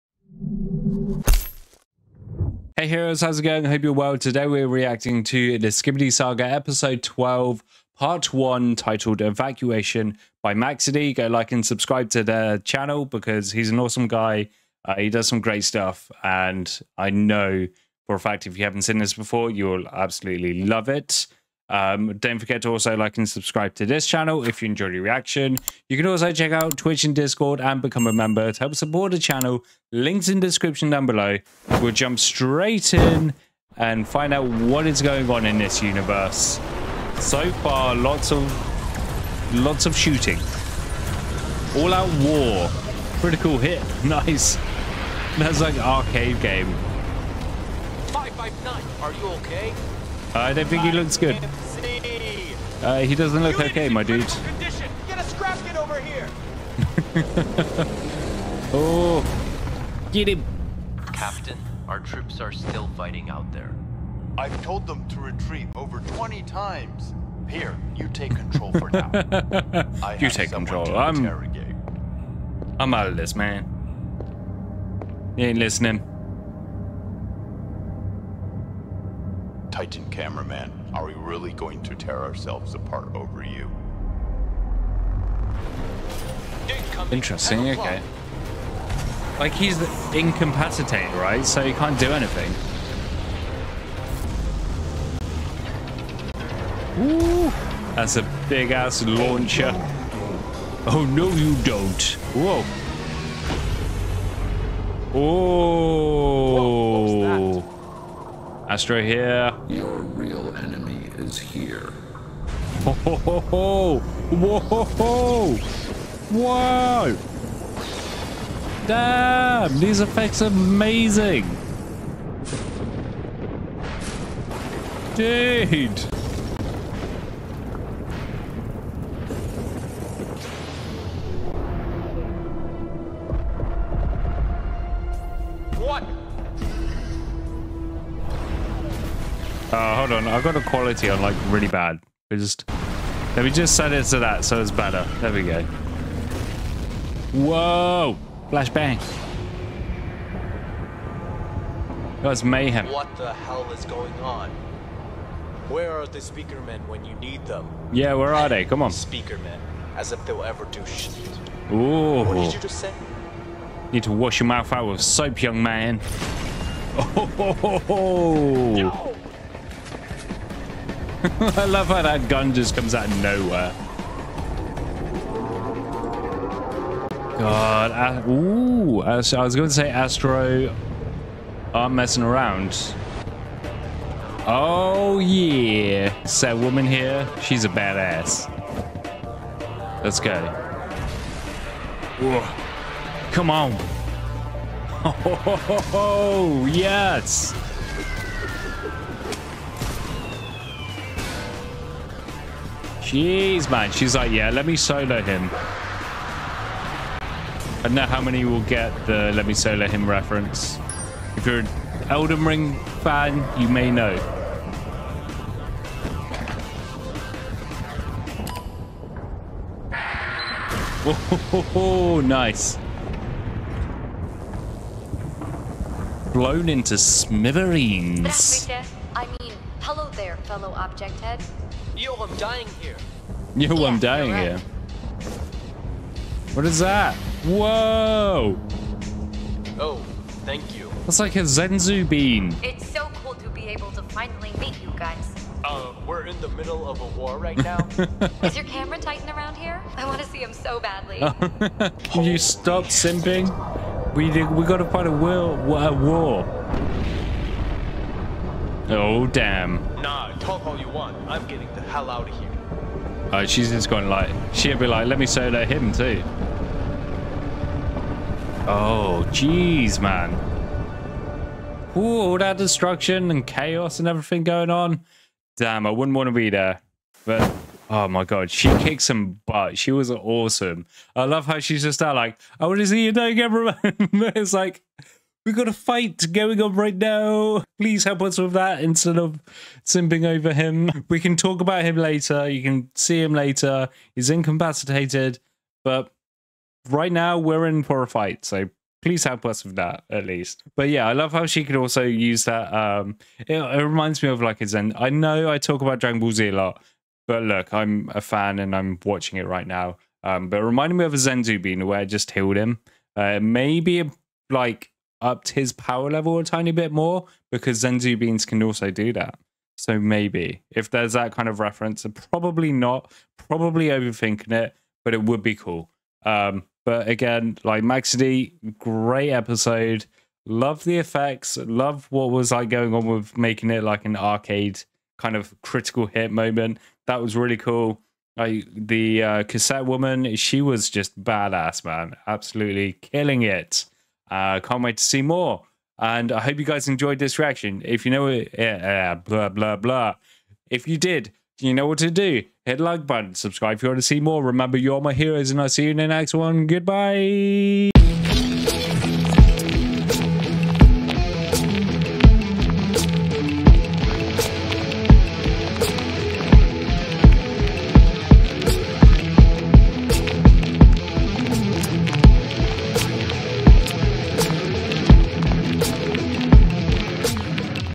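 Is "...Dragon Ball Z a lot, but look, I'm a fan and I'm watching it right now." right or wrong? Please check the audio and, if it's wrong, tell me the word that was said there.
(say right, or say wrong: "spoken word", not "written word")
right.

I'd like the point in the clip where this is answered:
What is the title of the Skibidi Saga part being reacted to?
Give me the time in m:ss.
0:09.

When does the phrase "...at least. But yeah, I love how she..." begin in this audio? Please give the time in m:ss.
5:00.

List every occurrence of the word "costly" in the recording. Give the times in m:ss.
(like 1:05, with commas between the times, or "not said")
not said.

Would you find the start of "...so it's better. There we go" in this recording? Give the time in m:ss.
2:24.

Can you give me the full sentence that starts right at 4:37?
But, oh my god, she kicked some butt.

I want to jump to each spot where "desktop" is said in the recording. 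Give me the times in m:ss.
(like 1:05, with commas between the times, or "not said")
not said.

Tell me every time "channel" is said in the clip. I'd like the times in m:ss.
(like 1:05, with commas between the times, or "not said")
0:12, 0:24, 0:29.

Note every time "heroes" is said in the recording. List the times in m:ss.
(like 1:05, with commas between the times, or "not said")
0:02, 5:55.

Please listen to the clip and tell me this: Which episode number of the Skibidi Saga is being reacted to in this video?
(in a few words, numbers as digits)
12.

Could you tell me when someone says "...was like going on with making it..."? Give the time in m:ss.
5:32.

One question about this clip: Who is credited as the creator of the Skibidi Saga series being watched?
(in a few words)
Maxedy.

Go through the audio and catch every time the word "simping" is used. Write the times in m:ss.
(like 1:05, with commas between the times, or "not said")
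4:12, 4:49.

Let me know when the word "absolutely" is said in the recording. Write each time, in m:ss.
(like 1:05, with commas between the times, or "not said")
0:19, 5:42.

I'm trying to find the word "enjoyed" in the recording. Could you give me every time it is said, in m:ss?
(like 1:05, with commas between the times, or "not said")
0:24, 5:46.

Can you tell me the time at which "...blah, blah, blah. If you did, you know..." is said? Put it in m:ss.
5:49.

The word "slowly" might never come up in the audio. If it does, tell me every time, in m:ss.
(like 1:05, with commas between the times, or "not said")
not said.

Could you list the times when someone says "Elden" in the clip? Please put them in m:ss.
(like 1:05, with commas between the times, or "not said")
3:32.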